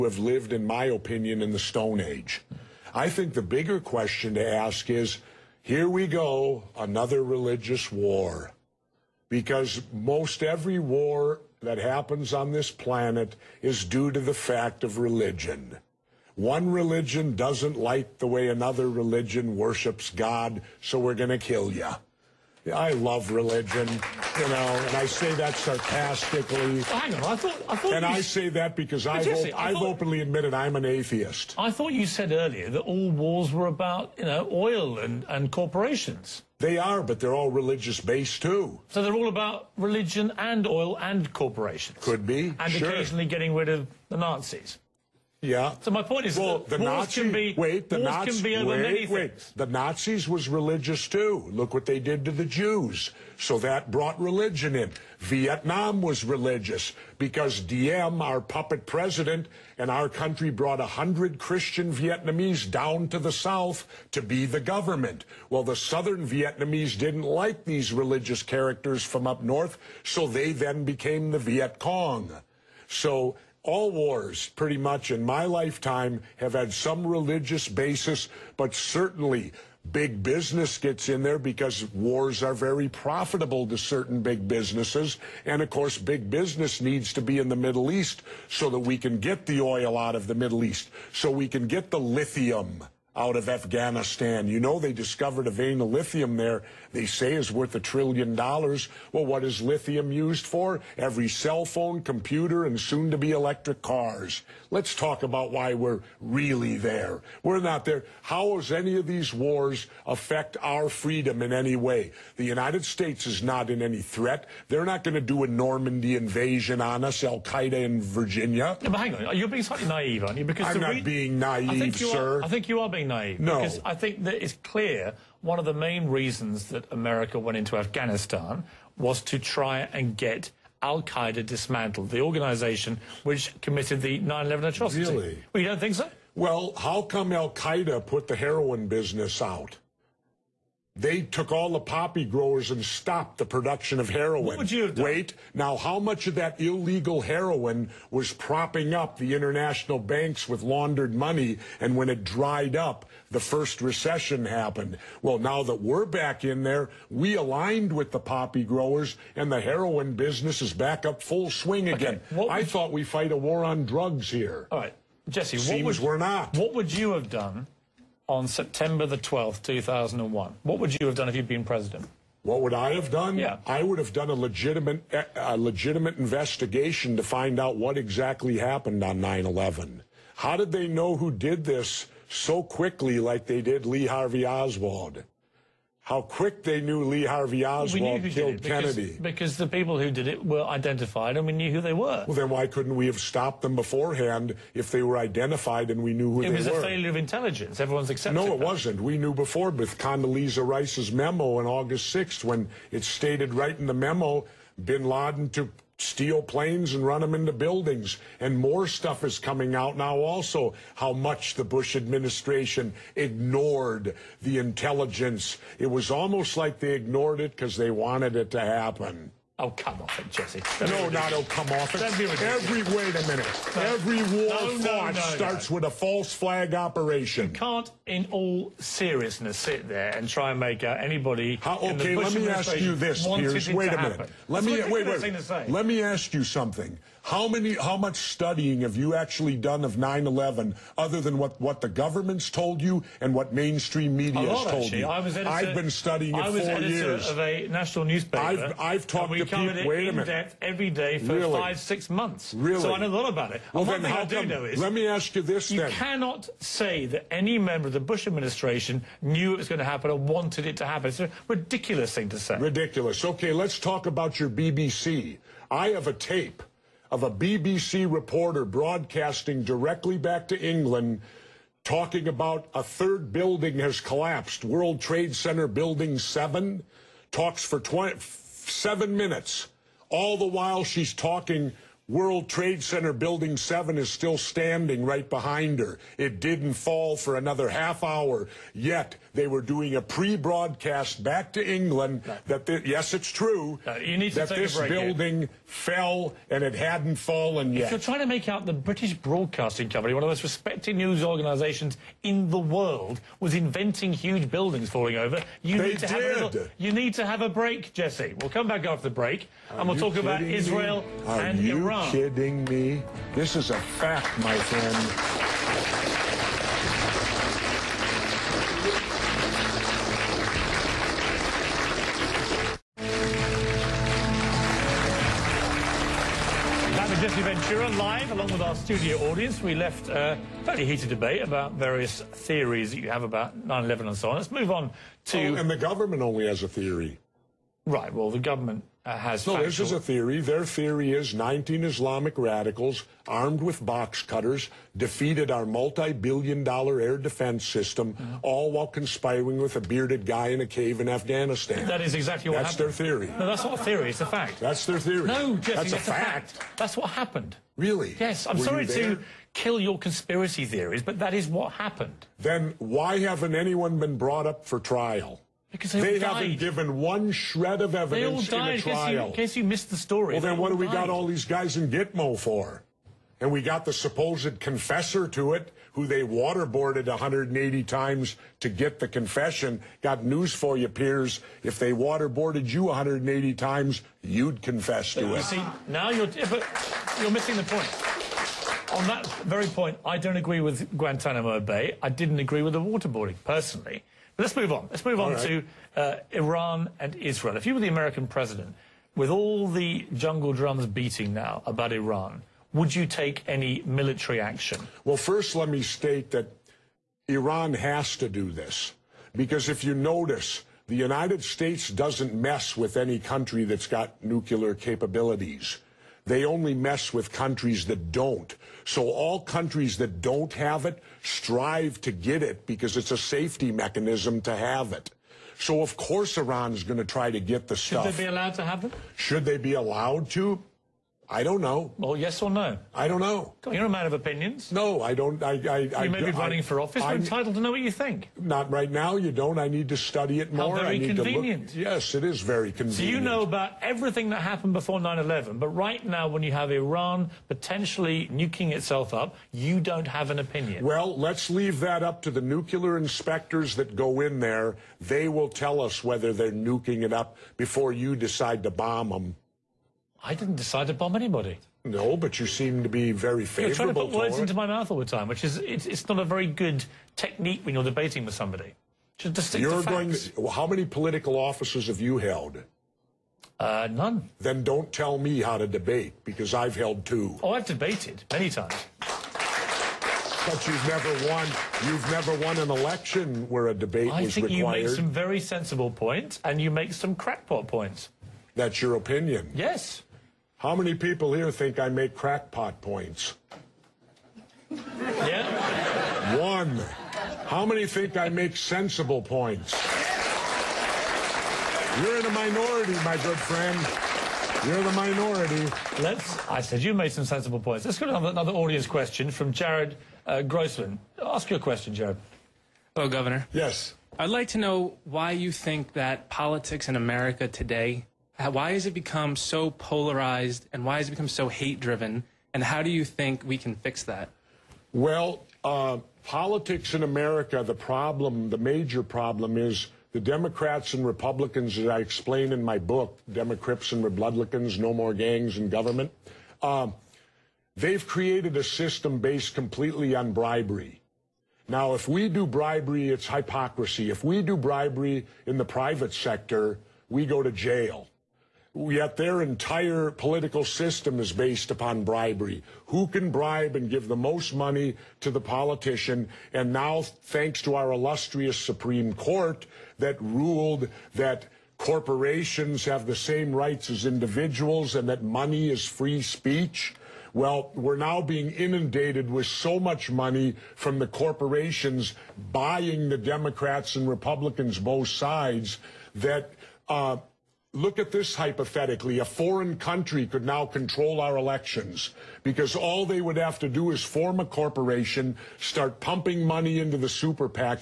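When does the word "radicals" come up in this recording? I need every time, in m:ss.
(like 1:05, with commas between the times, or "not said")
5:42.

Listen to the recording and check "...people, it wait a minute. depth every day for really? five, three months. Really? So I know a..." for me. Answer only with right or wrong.
wrong.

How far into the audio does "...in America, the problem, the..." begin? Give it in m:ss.
8:46.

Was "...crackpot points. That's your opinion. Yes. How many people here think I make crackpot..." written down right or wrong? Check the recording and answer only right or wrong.
right.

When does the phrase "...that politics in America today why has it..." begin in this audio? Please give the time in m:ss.
8:35.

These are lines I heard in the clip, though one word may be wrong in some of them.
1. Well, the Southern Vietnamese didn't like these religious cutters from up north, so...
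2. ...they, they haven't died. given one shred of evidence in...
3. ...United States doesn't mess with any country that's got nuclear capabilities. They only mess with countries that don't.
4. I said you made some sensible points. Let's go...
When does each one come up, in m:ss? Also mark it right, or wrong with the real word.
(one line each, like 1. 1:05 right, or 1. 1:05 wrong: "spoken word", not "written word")
1. 1:05 wrong: "characters", not "cutters"
2. 6:05 right
3. 6:50 right
4. 8:26 right.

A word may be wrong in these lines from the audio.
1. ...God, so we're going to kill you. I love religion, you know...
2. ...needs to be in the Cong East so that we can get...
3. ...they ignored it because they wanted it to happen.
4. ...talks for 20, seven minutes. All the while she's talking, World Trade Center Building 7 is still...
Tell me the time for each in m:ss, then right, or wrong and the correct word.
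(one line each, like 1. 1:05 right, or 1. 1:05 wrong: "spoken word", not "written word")
1. 0:20 right
2. 1:26 wrong: "Middle", not "Cong"
3. 3:36 right
4. 4:37 right.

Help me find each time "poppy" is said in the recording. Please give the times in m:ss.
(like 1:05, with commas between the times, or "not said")
2:21, 2:38.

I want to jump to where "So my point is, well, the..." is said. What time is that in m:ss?
0:45.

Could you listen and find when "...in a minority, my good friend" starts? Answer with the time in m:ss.
8:22.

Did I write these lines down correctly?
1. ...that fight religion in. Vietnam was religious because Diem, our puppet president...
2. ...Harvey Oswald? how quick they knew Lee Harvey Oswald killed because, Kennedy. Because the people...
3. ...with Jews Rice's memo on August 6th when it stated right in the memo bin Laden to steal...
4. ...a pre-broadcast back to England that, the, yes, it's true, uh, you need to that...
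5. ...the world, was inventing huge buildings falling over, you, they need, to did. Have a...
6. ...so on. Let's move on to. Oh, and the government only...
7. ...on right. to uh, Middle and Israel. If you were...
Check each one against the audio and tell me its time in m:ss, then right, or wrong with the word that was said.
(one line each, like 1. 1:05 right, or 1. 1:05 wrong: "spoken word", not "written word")
1. 0:53 wrong: "brought", not "fight"
2. 3:04 right
3. 3:19 wrong: "Condoleezza", not "Jews"
4. 4:49 right
5. 5:02 right
6. 5:34 right
7. 6:35 wrong: "Iran", not "Middle".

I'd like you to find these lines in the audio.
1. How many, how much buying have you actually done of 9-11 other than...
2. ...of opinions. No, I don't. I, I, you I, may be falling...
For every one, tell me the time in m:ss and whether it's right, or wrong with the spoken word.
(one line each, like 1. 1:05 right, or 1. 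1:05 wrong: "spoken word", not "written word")
1. 3:57 wrong: "studying", not "buying"
2. 7:14 wrong: "running", not "falling".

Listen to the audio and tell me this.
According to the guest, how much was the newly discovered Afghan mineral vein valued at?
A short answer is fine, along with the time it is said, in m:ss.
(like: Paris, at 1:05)
a trillion dollars, at 1:37.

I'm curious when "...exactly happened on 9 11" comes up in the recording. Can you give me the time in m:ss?
2:57.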